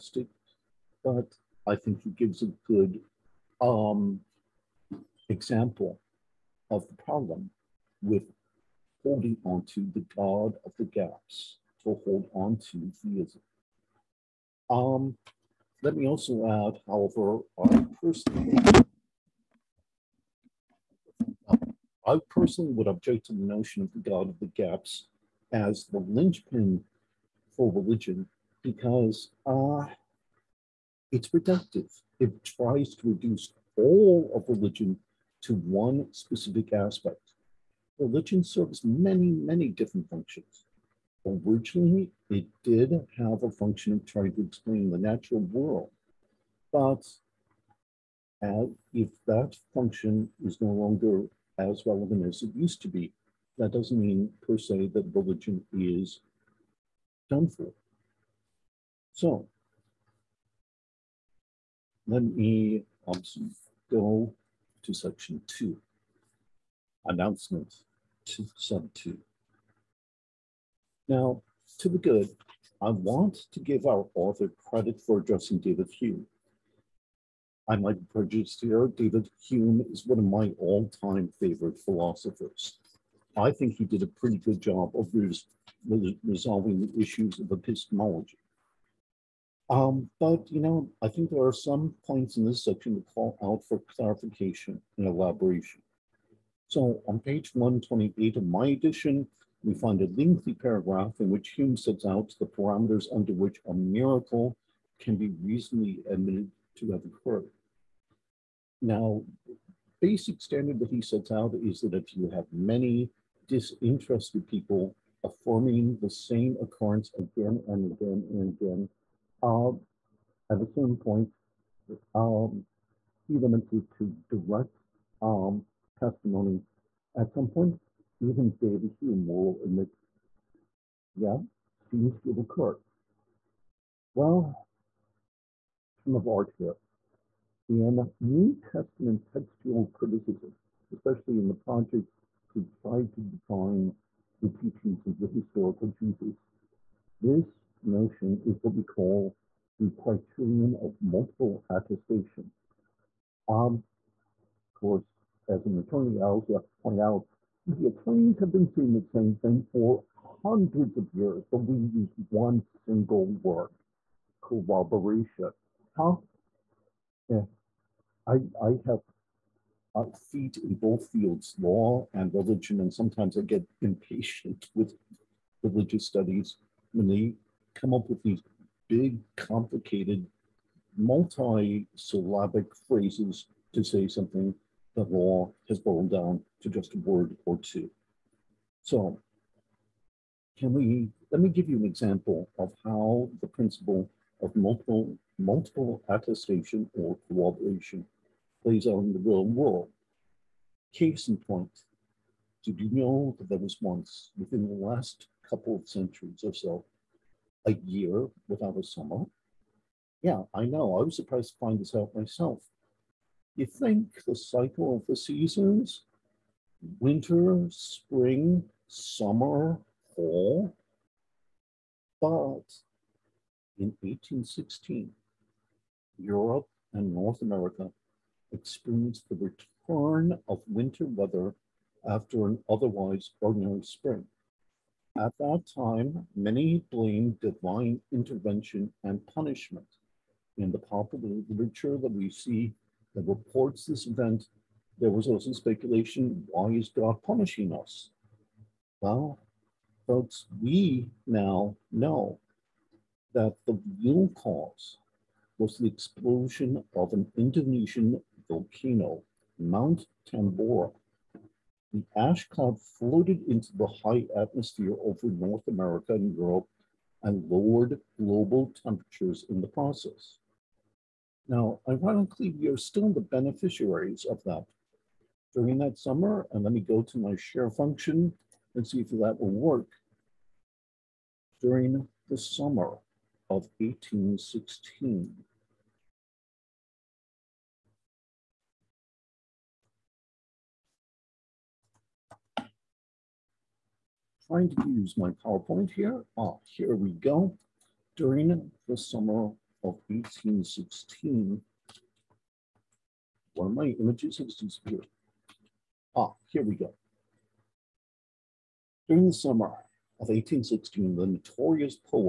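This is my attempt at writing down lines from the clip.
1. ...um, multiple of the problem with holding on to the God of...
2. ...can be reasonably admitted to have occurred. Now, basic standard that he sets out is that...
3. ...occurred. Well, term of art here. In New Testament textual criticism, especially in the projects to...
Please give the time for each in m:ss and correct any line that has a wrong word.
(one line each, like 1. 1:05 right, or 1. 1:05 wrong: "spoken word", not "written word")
1. 0:03 wrong: "example", not "multiple"
2. 1:44 right
3. 2:12 right.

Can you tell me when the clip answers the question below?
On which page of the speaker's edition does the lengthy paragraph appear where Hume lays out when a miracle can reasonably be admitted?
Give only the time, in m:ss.
1:37.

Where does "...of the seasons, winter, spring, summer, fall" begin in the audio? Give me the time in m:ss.
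3:34.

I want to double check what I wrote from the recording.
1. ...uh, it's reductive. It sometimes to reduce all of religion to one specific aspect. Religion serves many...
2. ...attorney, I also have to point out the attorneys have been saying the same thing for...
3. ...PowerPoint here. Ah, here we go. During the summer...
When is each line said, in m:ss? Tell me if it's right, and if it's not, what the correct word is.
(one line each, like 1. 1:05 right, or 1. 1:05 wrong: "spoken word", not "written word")
1. 0:29 wrong: "tries", not "sometimes"
2. 2:35 right
3. 4:55 right.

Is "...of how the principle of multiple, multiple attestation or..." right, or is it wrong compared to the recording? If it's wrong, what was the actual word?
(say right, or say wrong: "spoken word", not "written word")
right.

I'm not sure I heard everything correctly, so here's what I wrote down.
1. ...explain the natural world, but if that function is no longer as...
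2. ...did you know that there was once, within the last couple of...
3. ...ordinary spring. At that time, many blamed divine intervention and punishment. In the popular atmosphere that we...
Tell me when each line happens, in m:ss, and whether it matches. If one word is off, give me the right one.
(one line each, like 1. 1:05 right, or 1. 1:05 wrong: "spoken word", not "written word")
1. 0:44 right
2. 3:22 right
3. 3:53 wrong: "literature", not "atmosphere".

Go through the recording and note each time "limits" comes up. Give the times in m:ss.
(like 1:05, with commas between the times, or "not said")
2:03.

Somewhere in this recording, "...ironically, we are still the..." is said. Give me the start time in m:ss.
4:31.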